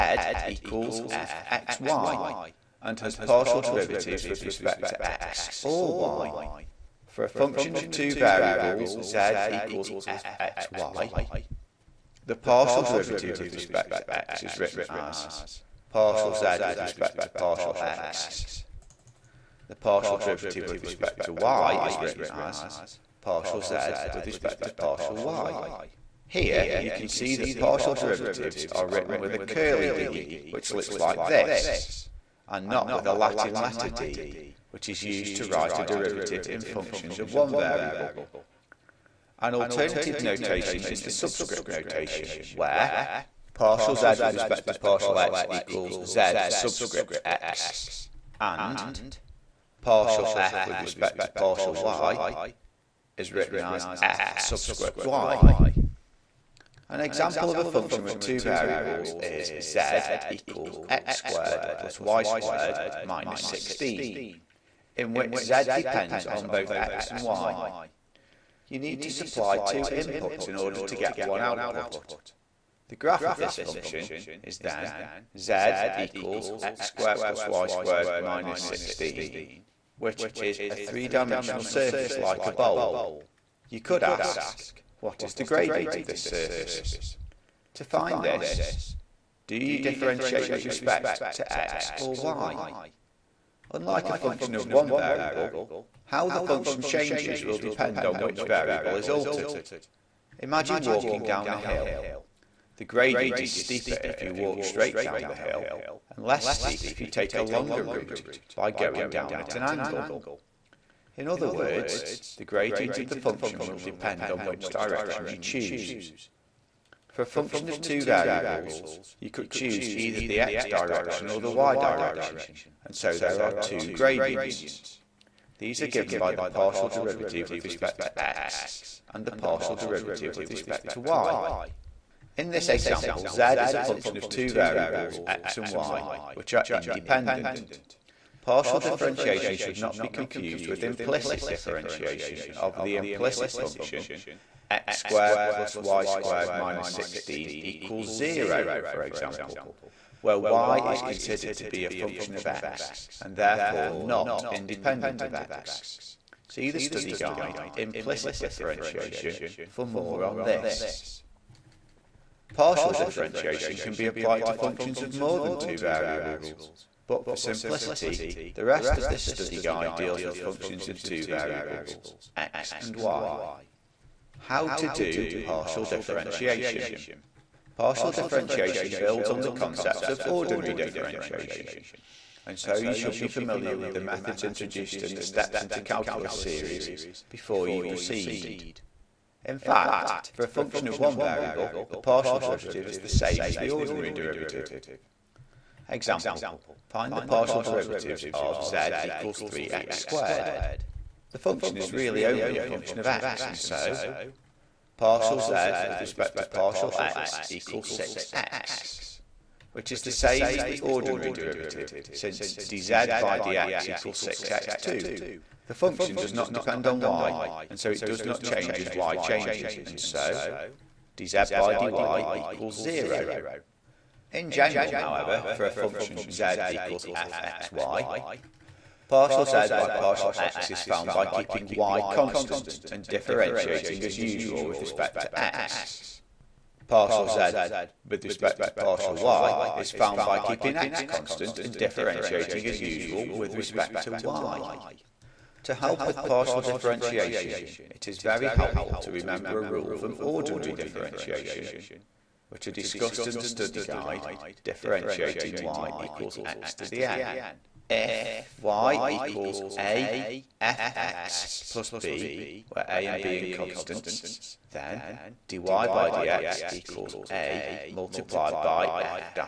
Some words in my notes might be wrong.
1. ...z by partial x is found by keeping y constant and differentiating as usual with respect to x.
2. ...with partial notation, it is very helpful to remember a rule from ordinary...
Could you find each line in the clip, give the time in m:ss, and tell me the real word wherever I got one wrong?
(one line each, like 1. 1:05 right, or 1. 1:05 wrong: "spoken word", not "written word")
1. 3:49 right
2. 4:06 wrong: "differentiation", not "notation".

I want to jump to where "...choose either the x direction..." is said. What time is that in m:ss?
1:59.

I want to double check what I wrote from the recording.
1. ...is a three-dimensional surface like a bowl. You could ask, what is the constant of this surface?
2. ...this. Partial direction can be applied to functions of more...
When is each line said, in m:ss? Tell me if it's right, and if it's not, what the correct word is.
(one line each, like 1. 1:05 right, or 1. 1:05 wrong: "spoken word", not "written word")
1. 1:20 wrong: "gradient", not "constant"
2. 2:40 wrong: "differentiation", not "direction".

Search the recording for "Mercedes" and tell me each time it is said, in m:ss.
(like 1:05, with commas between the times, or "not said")
not said.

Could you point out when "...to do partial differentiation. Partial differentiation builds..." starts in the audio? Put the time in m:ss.
2:54.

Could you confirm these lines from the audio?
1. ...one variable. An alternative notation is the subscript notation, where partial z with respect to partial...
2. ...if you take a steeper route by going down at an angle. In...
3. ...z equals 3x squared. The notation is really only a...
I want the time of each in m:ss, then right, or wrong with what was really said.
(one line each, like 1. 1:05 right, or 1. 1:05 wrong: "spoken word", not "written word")
1. 0:37 right
2. 1:46 wrong: "longer", not "steeper"
3. 3:18 wrong: "function", not "notation".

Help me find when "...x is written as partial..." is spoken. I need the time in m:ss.
0:14.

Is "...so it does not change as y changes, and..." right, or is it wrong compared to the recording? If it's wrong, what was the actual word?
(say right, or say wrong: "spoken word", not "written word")
right.